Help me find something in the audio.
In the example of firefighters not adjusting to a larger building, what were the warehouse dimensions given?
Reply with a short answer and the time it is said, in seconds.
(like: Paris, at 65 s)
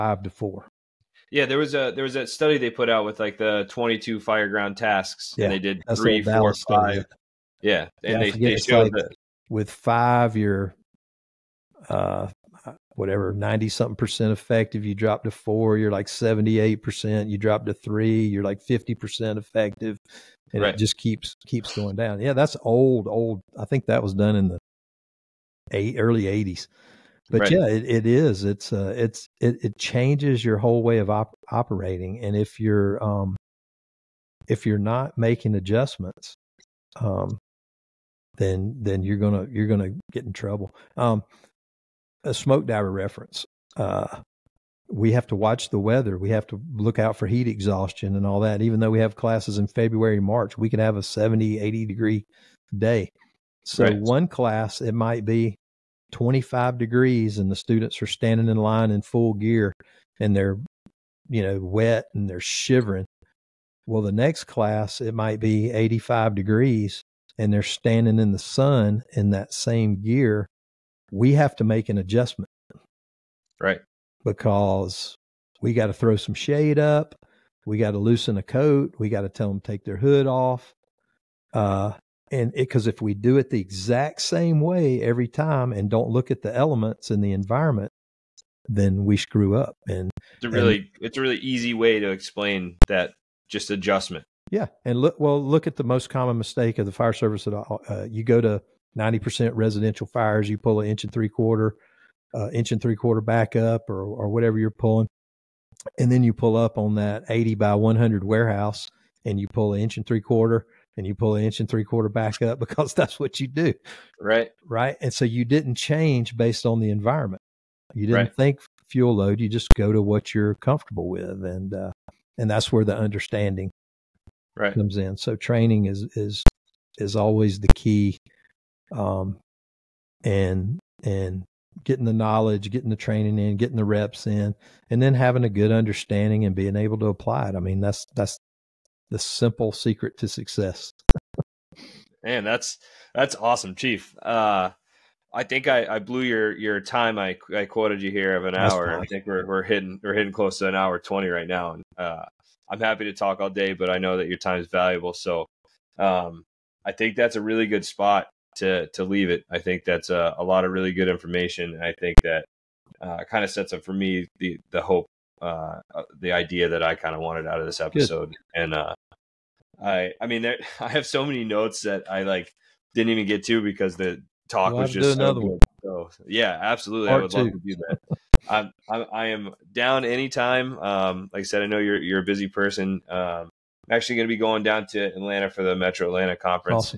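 80 by 100, at 107 s.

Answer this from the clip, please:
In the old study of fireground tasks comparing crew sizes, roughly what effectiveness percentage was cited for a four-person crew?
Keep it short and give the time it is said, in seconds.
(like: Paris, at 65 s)
78 percent, at 16 s.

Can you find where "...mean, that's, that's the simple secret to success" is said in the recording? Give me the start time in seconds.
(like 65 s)
137 s.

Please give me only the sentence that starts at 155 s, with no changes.
So um, I think that's a really good spot to to leave it.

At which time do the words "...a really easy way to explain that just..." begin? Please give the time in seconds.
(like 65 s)
91 s.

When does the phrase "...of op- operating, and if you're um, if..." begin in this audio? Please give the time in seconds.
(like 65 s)
30 s.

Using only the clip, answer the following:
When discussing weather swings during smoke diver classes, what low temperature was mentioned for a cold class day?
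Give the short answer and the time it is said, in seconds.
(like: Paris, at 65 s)
25 degrees, at 56 s.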